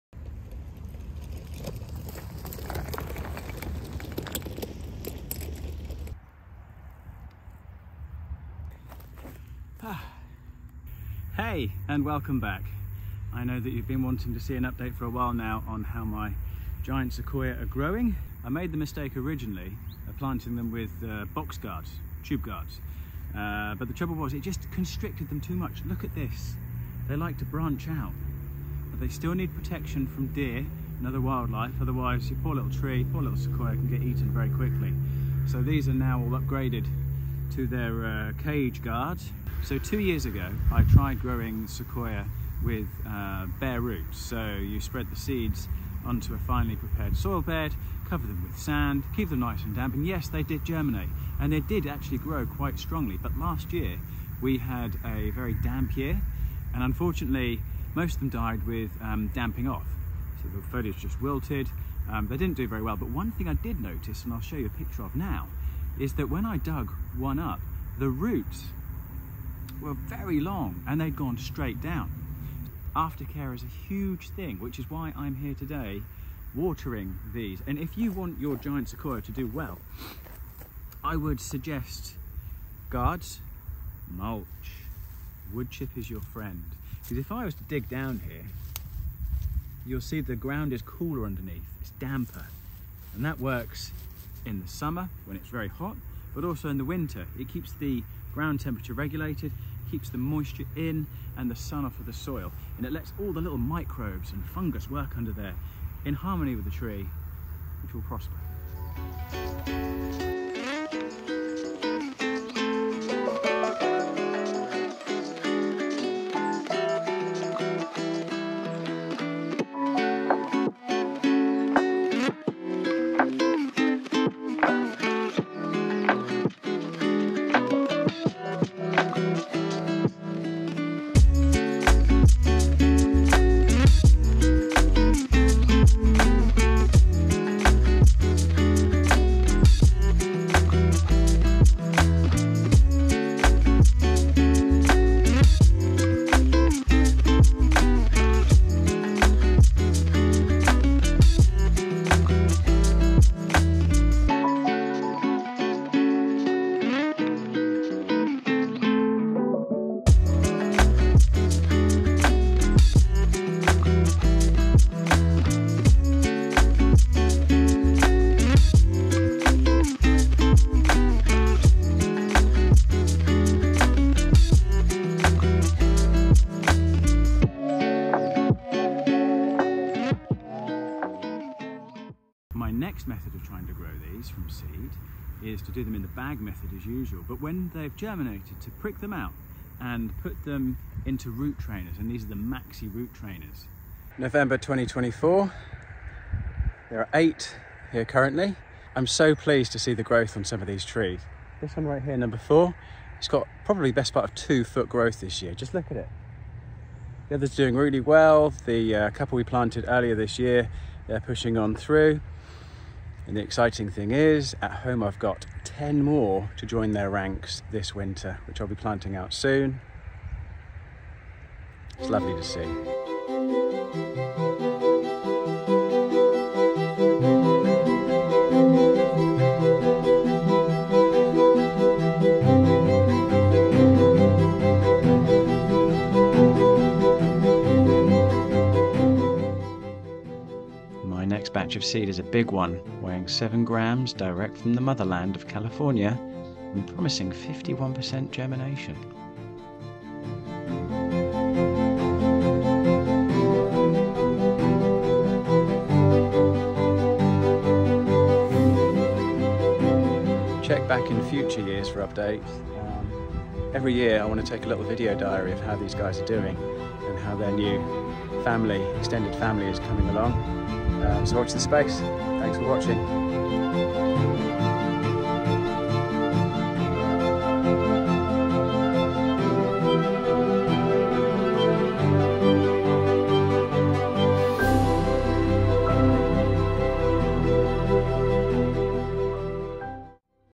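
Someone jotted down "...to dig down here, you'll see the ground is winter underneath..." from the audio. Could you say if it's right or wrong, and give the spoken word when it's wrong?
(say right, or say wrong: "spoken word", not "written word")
wrong: "cooler", not "winter".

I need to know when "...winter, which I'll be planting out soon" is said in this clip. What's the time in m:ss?
3:37.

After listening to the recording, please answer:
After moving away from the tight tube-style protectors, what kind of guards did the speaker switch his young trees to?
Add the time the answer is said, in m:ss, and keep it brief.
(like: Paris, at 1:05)
cage guards, at 0:38.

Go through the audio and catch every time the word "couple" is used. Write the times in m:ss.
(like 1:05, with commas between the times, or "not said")
3:29.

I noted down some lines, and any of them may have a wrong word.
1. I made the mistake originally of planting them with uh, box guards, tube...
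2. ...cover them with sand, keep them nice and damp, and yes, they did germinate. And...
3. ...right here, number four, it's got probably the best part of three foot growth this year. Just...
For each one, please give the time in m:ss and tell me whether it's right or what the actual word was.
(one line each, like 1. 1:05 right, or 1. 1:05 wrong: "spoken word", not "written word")
1. 0:18 right
2. 0:48 right
3. 3:21 wrong: "two", not "three".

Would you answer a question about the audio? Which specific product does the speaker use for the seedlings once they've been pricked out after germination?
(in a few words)
maxi root trainers.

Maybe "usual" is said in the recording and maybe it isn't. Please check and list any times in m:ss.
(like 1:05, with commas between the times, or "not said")
3:06.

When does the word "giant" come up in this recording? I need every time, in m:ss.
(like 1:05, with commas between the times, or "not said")
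0:16, 1:18.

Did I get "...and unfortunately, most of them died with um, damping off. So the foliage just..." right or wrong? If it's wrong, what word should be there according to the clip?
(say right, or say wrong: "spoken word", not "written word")
right.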